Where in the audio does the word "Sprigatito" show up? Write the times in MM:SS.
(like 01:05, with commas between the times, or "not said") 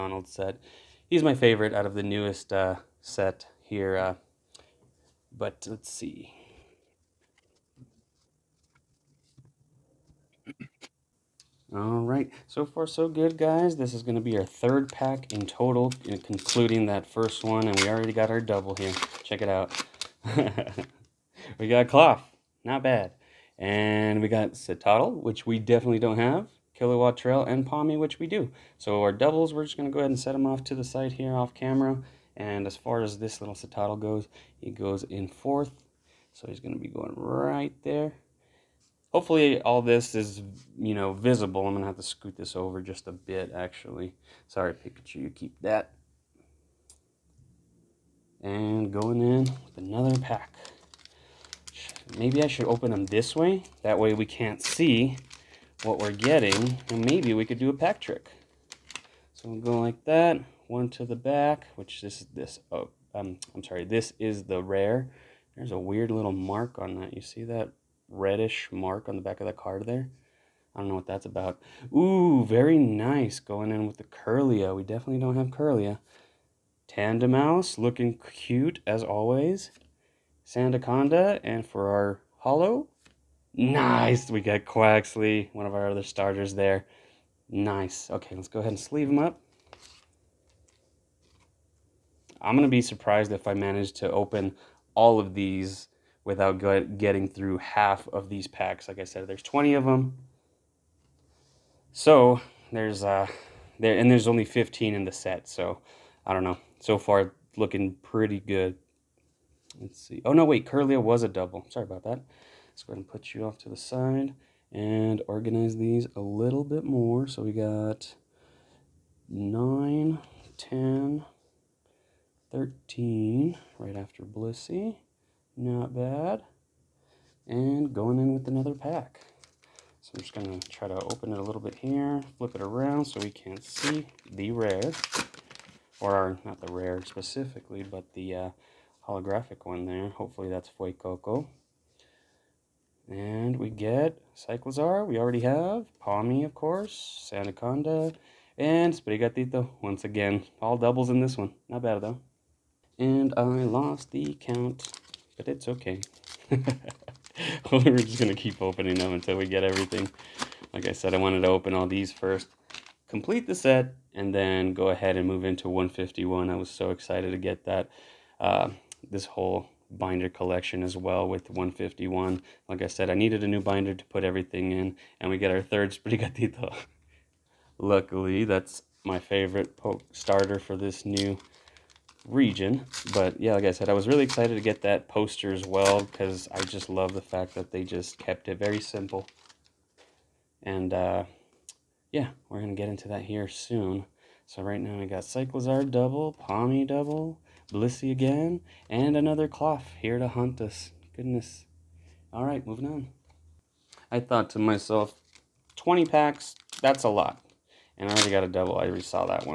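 02:28, 02:55.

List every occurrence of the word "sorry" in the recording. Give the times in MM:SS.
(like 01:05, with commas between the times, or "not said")
00:44, 01:03, 01:51.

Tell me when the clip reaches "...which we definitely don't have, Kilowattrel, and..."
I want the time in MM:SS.
00:25.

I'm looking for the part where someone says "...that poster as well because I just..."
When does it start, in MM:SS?
03:04.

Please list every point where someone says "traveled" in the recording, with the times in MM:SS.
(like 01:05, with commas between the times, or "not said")
not said.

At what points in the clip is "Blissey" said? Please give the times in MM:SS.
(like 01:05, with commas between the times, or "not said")
02:04, 03:17.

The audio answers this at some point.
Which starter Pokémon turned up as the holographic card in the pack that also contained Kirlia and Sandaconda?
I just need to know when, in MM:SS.
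01:24.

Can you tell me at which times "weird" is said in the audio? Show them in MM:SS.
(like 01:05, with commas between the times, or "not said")
01:05.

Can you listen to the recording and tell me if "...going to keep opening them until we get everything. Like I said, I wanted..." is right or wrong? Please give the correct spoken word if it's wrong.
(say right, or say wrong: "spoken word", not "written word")
right.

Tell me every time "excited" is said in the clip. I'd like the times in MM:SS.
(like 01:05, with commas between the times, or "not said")
02:46, 03:04.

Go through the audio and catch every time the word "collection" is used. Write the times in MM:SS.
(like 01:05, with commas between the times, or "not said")
02:50.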